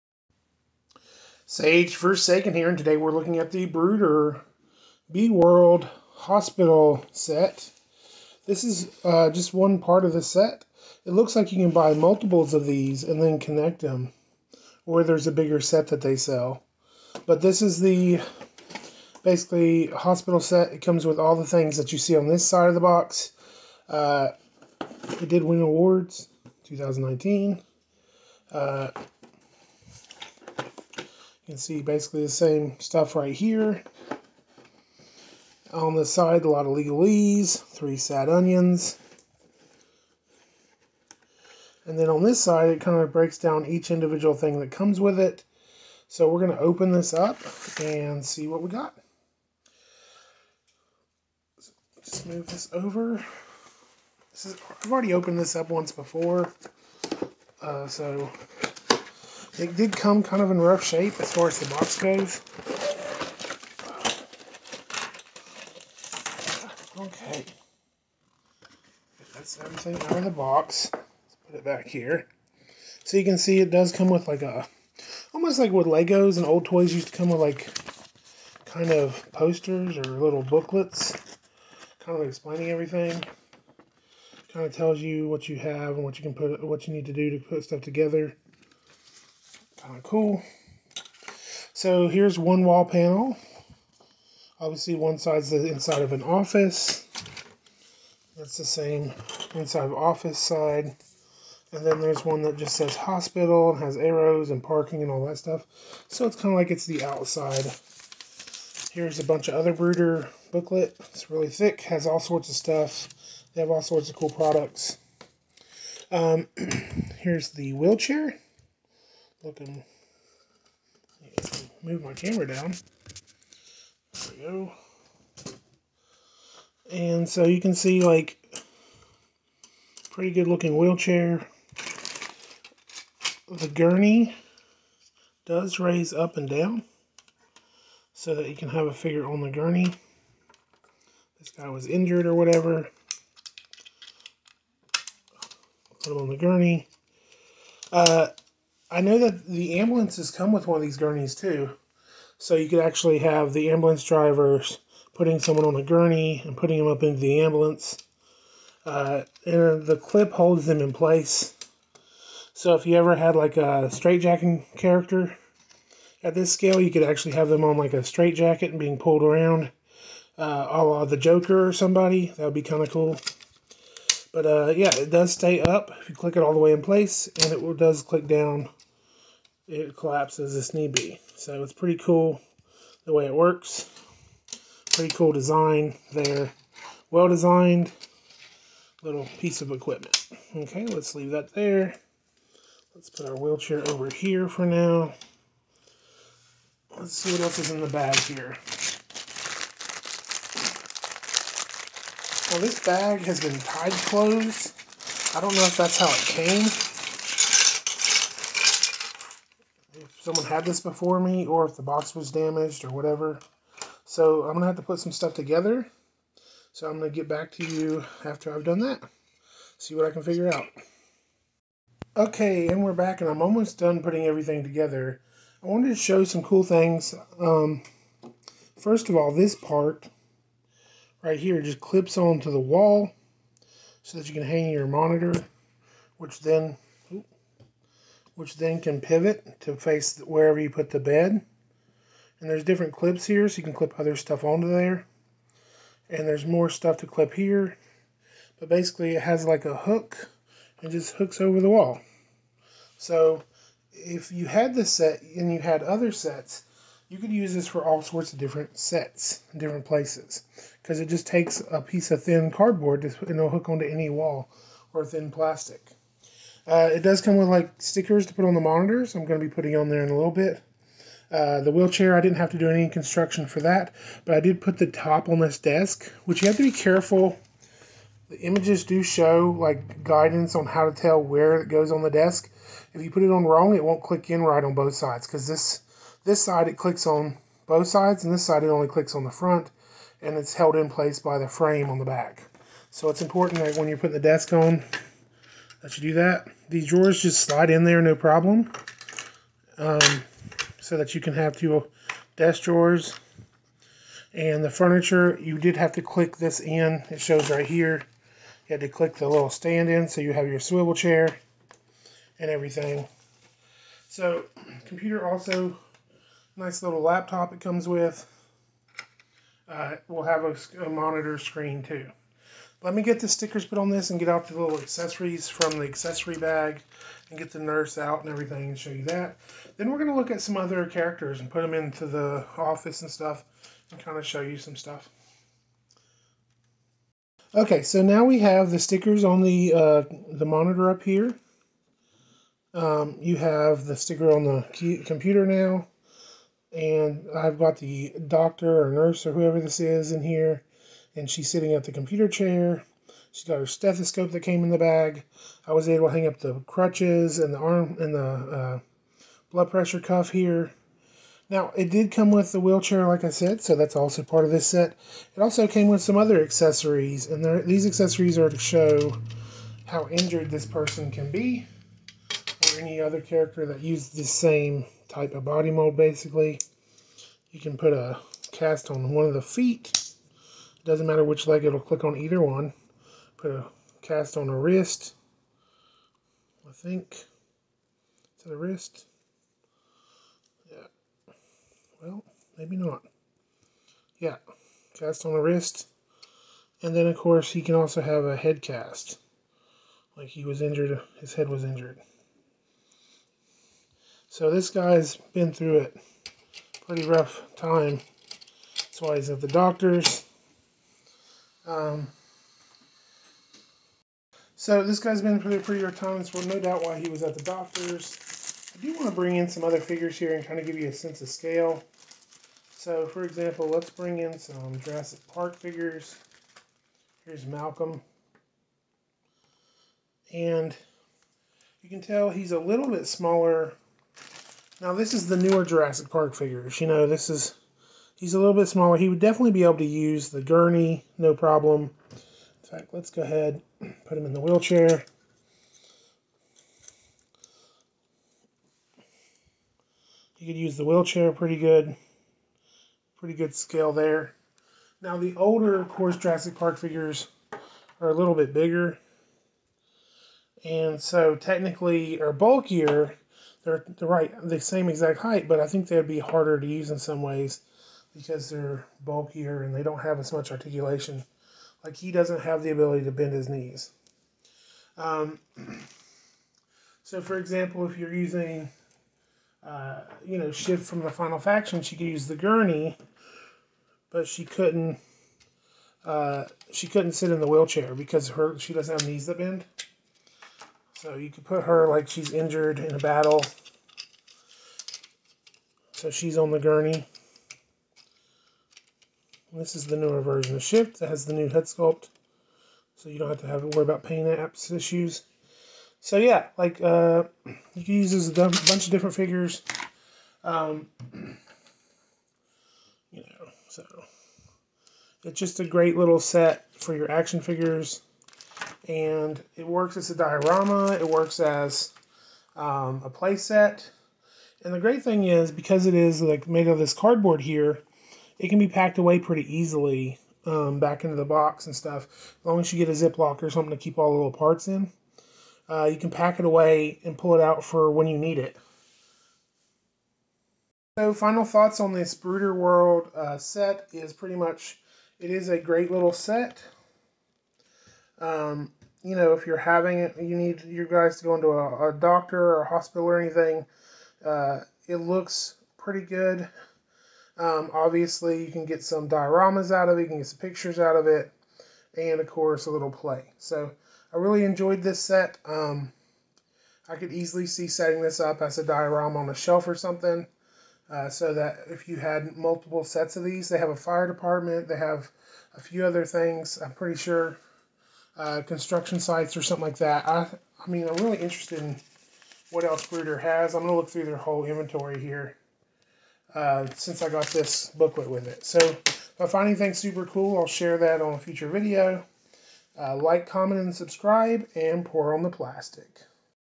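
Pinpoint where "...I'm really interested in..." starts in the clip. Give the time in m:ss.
9:40.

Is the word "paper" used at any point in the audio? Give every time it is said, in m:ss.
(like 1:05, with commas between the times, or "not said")
not said.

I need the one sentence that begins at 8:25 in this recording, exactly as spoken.
So yeah, like uh, you can use this a bunch of different figures.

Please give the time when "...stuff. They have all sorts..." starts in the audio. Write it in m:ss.
1:52.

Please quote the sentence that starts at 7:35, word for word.
Now the older, of course, Jurassic Park figures are a little bit bigger.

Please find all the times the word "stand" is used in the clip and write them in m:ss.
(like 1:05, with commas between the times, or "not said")
5:09.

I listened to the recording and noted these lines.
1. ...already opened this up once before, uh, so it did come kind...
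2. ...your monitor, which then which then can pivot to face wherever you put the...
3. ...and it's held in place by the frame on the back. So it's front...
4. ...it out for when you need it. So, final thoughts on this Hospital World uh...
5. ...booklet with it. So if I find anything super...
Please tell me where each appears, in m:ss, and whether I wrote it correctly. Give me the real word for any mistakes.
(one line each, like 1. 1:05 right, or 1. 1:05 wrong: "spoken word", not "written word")
1. 0:54 right
2. 3:54 right
3. 4:50 wrong: "important", not "front"
4. 8:57 wrong: "Bruder", not "Hospital"
5. 9:47 right.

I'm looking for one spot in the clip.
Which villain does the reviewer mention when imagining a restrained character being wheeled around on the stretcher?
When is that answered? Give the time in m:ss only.
2:51.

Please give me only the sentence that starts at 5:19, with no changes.
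Uh, we'll have a, a monitor screen too.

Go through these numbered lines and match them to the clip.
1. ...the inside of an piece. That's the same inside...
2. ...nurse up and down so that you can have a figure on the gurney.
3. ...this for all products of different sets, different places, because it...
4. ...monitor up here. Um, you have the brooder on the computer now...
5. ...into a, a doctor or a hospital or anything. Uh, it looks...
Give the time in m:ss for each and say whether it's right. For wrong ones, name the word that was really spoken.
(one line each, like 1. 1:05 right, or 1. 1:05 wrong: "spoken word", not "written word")
1. 1:35 wrong: "office", not "piece"
2. 2:15 wrong: "raise", not "nurse"
3. 4:17 wrong: "sorts", not "products"
4. 5:40 wrong: "sticker", not "brooder"
5. 9:11 right.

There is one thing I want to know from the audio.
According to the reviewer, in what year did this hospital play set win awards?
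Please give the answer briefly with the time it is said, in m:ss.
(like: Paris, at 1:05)
2019, at 0:26.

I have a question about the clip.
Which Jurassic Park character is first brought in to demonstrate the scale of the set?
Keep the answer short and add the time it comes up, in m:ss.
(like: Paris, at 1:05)
Malcolm, at 7:07.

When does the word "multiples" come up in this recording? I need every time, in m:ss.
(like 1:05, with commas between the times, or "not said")
0:11, 9:32.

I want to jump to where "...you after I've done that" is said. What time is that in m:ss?
3:37.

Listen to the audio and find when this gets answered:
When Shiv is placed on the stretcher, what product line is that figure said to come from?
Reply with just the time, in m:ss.
8:01.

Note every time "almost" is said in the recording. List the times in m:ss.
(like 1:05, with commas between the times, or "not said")
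1:15, 3:43.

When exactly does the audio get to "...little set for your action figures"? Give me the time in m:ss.
8:35.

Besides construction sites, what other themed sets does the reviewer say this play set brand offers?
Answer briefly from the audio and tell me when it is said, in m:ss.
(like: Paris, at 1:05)
fire department, at 9:33.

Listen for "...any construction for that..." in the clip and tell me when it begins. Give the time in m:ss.
4:32.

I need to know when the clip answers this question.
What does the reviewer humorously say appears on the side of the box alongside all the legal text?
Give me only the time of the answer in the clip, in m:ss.
0:37.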